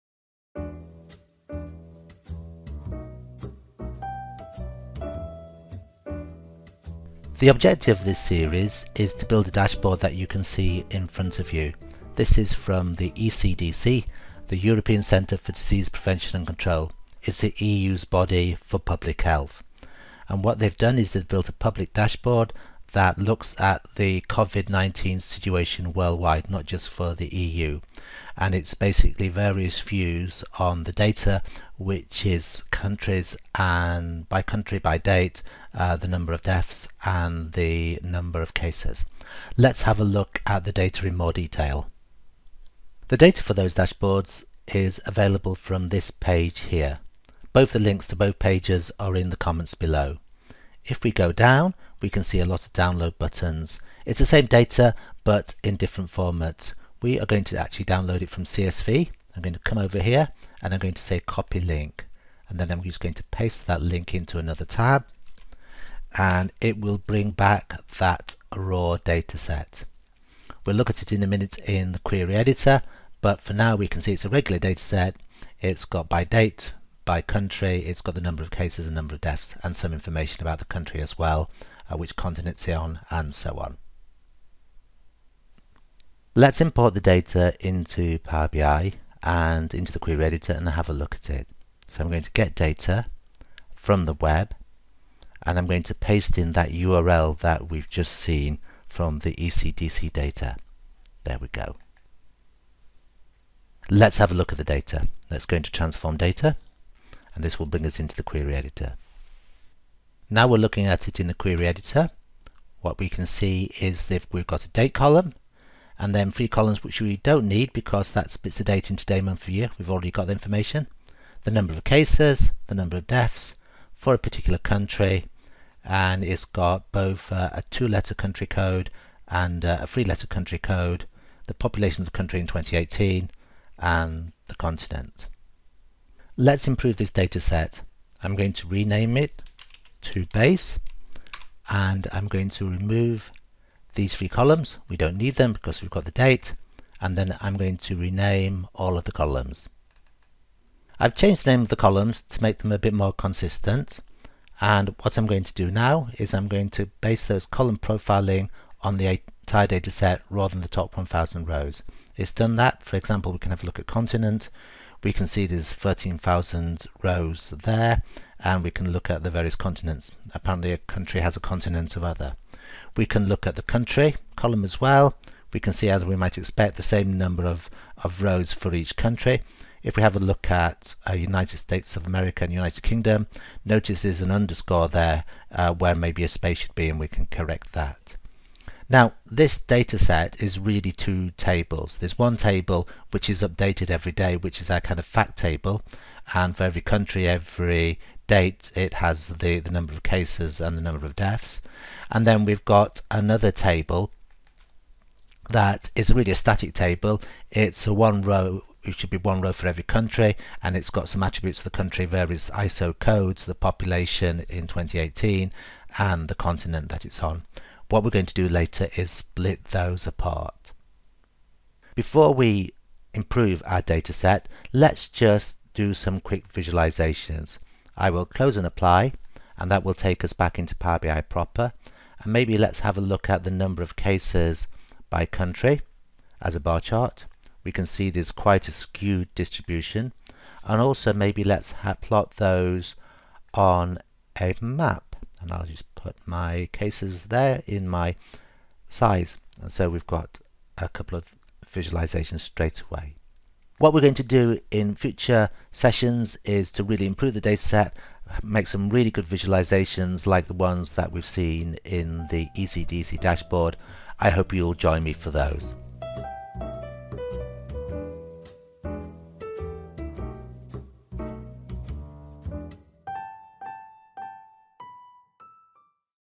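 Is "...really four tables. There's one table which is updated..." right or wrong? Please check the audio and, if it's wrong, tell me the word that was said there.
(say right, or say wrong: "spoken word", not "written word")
wrong: "two", not "four".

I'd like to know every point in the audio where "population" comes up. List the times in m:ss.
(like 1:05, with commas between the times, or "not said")
2:11, 3:33.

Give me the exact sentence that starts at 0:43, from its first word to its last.
The data for those dashboards is available from this page here.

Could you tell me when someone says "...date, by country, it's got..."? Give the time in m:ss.
1:16.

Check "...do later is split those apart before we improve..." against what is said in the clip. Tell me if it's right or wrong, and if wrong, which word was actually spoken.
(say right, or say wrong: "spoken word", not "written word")
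right.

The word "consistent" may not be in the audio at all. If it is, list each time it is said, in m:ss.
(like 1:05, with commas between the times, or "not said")
2:33.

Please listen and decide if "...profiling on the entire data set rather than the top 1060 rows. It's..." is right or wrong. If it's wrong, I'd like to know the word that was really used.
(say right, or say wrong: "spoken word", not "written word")
wrong: "1000", not "1060".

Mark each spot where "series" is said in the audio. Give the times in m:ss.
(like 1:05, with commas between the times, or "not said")
0:08.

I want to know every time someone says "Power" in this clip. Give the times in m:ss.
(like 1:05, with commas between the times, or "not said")
1:28, 3:50.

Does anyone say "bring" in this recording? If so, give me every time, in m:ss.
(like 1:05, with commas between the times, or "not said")
1:06, 1:47.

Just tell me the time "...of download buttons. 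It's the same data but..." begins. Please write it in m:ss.
0:52.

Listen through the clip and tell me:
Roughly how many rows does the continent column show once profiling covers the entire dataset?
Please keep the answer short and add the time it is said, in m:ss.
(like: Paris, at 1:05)
13,000, at 2:45.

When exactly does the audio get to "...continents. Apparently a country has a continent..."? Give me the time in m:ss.
2:49.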